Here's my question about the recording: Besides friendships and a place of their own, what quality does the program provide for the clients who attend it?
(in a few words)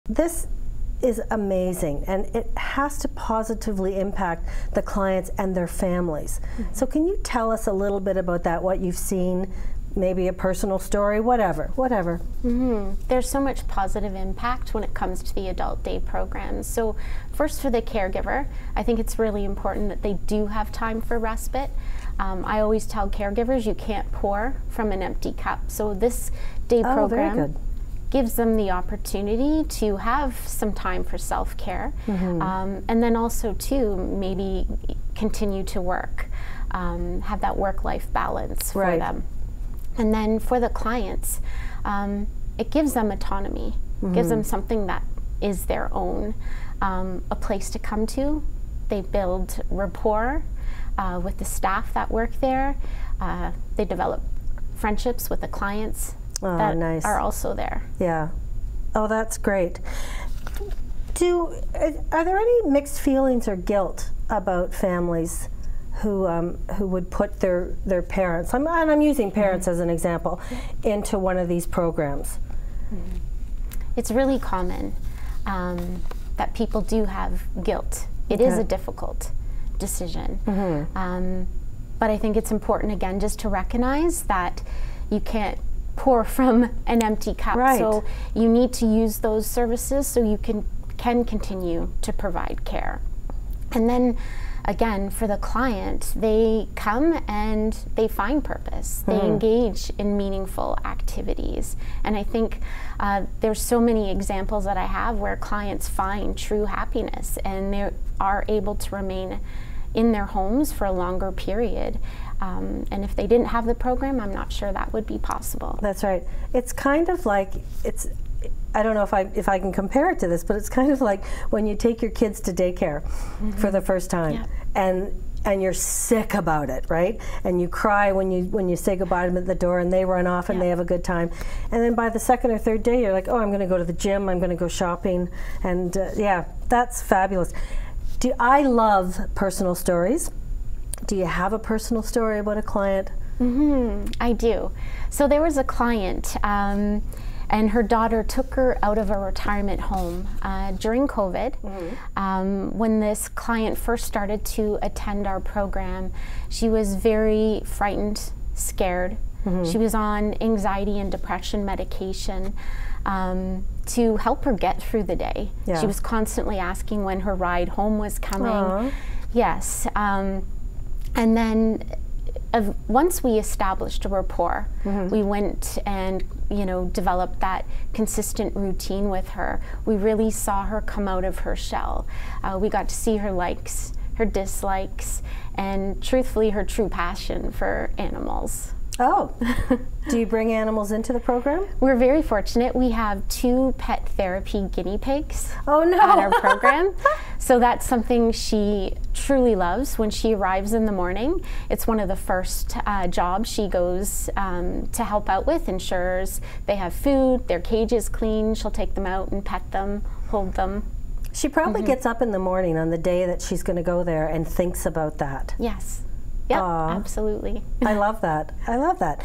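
autonomy.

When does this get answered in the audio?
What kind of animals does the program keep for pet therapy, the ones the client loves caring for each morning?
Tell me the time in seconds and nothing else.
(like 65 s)
194 s.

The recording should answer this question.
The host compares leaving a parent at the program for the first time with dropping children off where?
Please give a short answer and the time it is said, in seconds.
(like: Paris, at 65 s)
daycare, at 122 s.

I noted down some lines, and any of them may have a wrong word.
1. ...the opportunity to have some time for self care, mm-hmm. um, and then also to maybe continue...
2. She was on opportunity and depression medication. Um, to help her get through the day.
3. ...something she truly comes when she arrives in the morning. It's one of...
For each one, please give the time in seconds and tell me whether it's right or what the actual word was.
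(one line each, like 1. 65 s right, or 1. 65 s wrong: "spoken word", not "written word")
1. 28 s right
2. 159 s wrong: "anxiety", not "opportunity"
3. 197 s wrong: "loves", not "comes".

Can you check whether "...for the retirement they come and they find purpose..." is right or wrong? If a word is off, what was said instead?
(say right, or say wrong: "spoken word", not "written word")
wrong: "client", not "retirement".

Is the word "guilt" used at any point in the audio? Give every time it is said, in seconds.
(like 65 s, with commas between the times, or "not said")
63 s, 77 s.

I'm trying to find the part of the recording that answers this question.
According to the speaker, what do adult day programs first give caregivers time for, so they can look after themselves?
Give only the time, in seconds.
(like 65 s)
21 s.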